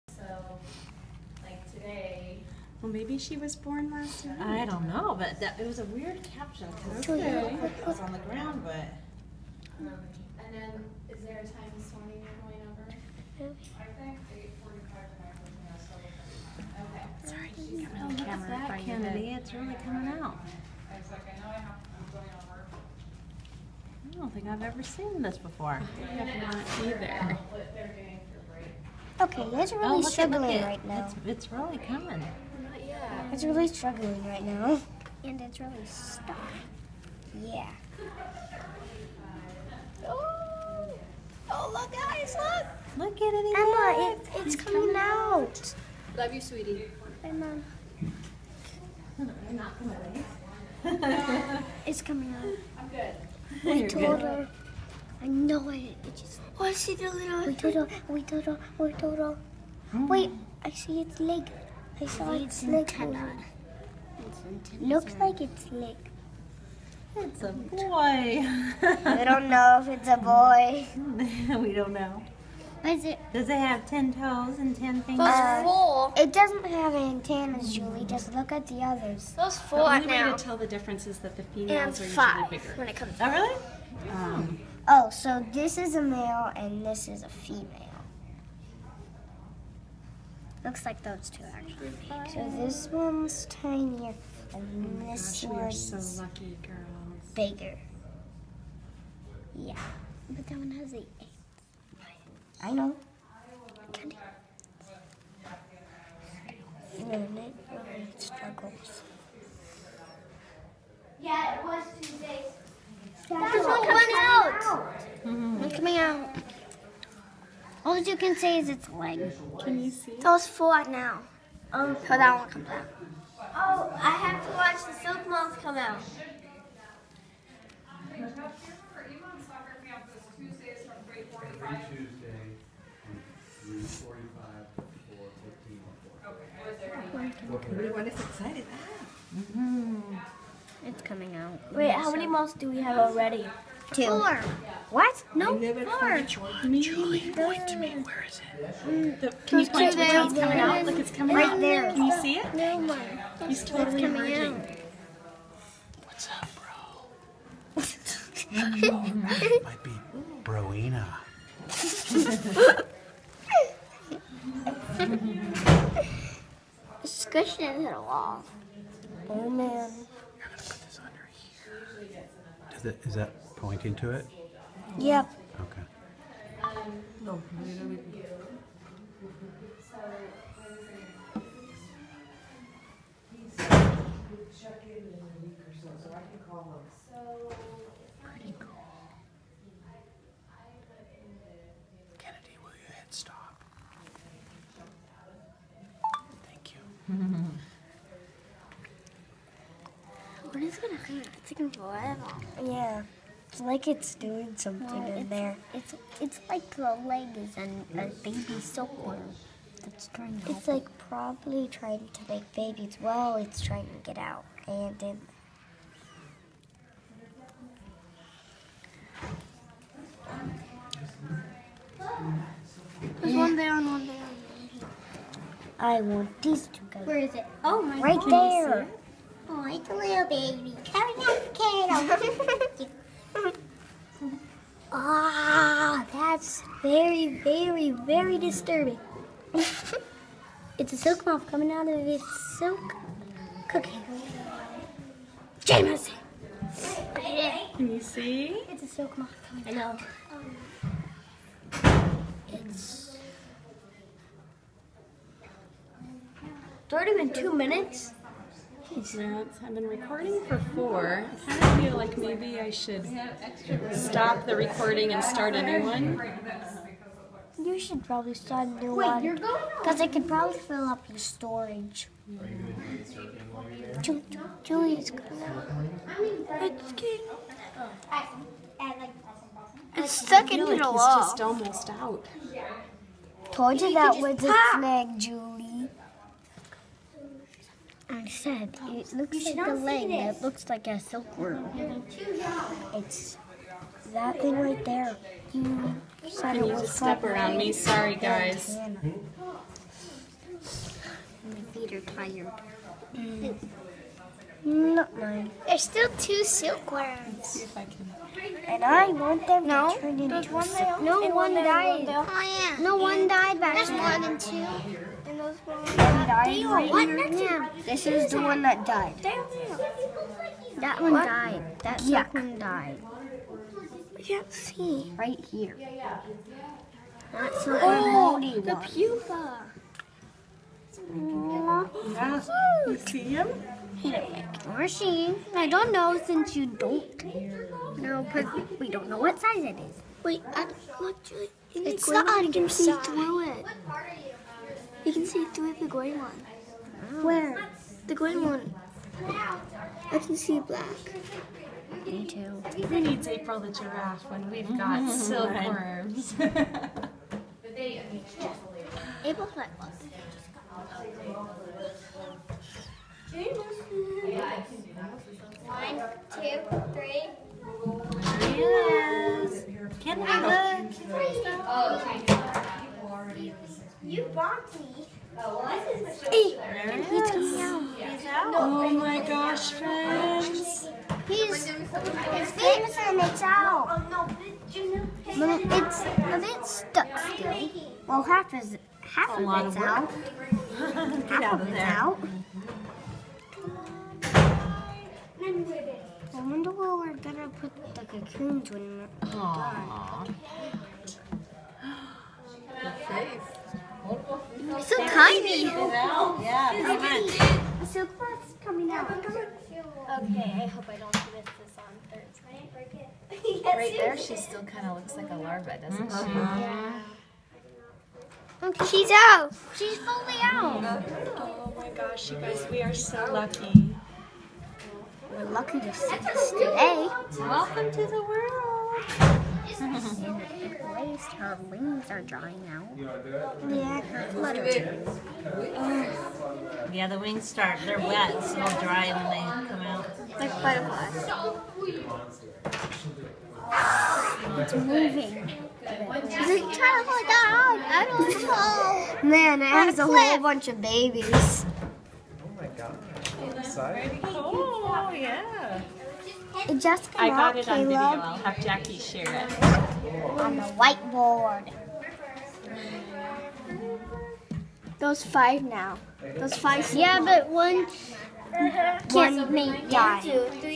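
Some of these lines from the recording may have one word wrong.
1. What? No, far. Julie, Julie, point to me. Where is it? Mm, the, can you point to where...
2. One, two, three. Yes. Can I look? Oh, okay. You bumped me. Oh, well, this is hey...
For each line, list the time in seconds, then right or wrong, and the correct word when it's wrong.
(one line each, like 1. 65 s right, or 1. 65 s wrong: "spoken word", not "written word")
1. 144 s right
2. 365 s right.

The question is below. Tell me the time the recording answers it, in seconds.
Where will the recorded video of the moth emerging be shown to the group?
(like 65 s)
460 s.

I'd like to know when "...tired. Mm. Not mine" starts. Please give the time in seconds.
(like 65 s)
302 s.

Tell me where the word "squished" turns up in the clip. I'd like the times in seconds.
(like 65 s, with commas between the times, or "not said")
167 s.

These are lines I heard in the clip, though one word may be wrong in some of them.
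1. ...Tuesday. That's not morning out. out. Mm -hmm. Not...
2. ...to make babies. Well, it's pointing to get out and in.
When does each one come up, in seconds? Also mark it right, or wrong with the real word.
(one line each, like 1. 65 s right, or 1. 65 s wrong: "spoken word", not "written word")
1. 111 s wrong: "coming", not "morning"
2. 212 s wrong: "trying", not "pointing".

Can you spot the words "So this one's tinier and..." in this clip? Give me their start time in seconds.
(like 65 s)
92 s.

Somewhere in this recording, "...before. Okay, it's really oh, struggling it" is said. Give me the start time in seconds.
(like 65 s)
25 s.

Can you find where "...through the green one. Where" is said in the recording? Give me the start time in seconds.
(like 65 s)
345 s.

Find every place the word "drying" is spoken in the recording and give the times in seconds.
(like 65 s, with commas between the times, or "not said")
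432 s.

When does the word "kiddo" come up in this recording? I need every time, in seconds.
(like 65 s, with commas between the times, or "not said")
232 s.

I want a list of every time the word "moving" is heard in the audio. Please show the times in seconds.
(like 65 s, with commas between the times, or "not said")
444 s.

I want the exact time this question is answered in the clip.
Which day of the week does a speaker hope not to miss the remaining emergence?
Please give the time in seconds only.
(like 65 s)
412 s.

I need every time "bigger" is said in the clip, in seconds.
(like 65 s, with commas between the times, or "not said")
82 s, 97 s.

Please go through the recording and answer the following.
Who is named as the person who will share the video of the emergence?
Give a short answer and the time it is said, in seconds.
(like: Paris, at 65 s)
Jackie, at 458 s.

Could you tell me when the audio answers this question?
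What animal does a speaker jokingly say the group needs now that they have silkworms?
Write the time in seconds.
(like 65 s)
353 s.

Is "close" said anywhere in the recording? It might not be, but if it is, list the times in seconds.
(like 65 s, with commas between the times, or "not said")
408 s.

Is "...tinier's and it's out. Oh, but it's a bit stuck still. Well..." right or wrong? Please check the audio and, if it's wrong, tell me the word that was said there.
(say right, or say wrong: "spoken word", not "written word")
wrong: "finger", not "tinier".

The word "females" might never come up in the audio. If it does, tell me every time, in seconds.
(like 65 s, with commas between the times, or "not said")
81 s, 87 s.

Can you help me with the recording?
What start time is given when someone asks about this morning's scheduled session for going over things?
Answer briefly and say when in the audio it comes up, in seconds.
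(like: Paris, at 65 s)
8:45, at 14 s.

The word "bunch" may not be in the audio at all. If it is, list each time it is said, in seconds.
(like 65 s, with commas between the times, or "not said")
450 s.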